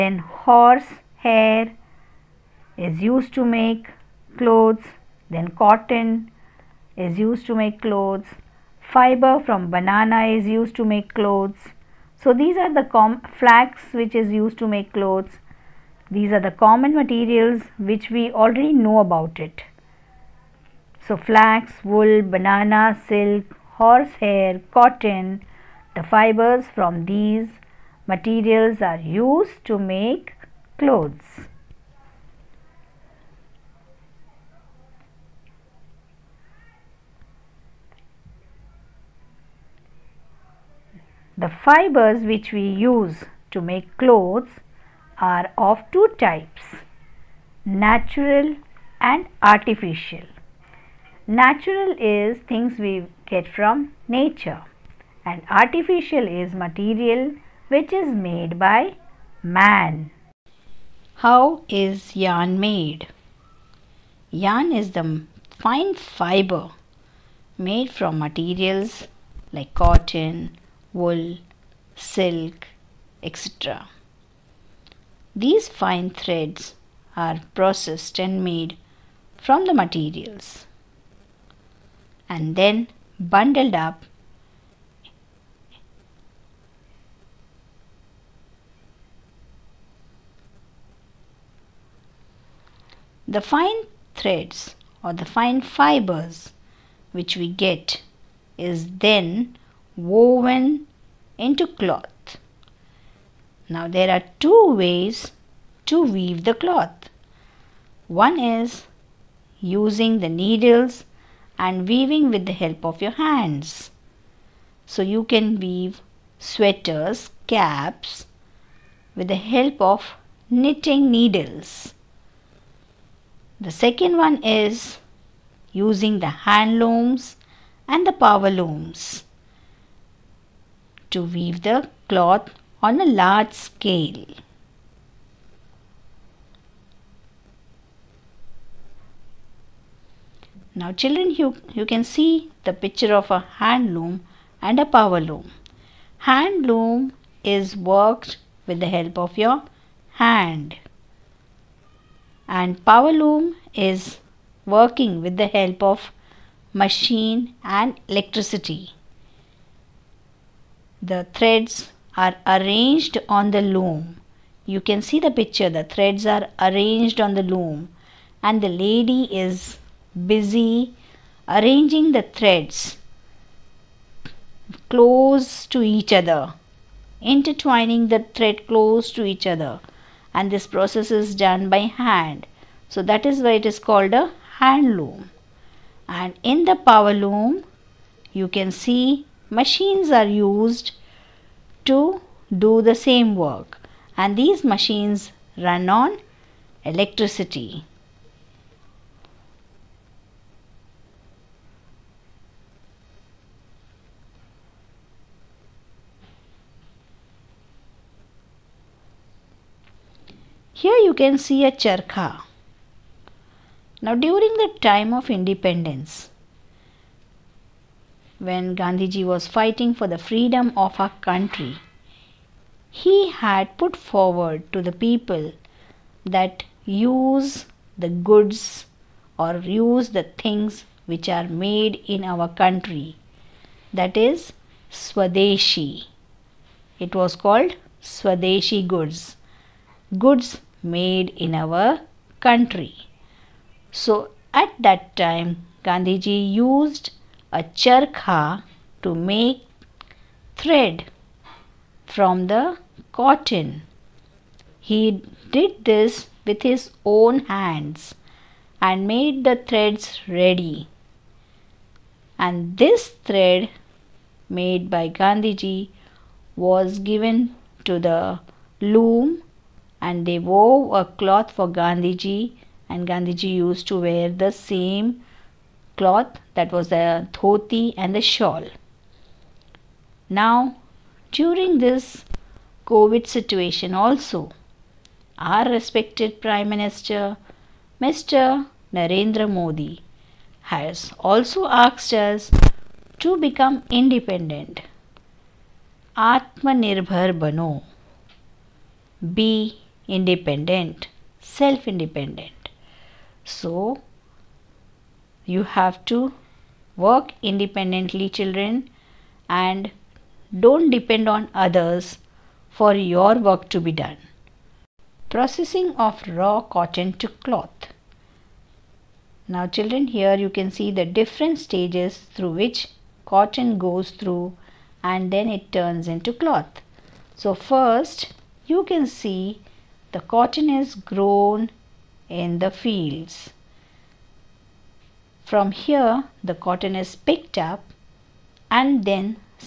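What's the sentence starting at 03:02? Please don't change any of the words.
So, that is why it is called a hand loom.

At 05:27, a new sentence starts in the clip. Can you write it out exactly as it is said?
So first you can see the cotton is grown in the fields.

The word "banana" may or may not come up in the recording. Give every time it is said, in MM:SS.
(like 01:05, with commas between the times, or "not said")
00:09, 00:22.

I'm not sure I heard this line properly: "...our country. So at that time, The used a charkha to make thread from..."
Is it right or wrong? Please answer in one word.
wrong.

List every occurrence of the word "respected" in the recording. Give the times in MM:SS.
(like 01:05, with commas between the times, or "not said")
04:45.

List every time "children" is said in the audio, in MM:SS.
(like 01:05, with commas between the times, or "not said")
02:20, 05:08, 05:19.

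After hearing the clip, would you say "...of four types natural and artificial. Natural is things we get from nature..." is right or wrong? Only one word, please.
wrong.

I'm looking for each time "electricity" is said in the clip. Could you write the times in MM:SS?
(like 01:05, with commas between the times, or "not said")
02:38, 03:16.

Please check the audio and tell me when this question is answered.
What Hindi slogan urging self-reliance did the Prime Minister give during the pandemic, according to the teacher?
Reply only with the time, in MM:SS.
04:56.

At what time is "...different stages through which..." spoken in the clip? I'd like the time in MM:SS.
05:21.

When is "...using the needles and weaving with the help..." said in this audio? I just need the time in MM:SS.
01:49.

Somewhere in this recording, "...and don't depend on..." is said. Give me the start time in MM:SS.
05:09.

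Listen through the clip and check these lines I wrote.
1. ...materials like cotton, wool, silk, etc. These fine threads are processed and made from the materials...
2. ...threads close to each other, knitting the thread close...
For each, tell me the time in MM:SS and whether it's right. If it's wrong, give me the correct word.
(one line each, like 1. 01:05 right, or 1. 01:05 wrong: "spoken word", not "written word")
1. 01:08 right
2. 02:52 wrong: "intertwining", not "knitting".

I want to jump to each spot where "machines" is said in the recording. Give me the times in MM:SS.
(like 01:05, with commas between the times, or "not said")
02:36, 03:09, 03:14.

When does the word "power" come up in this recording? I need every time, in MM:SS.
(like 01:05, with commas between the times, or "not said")
02:08, 02:24, 02:32, 03:06.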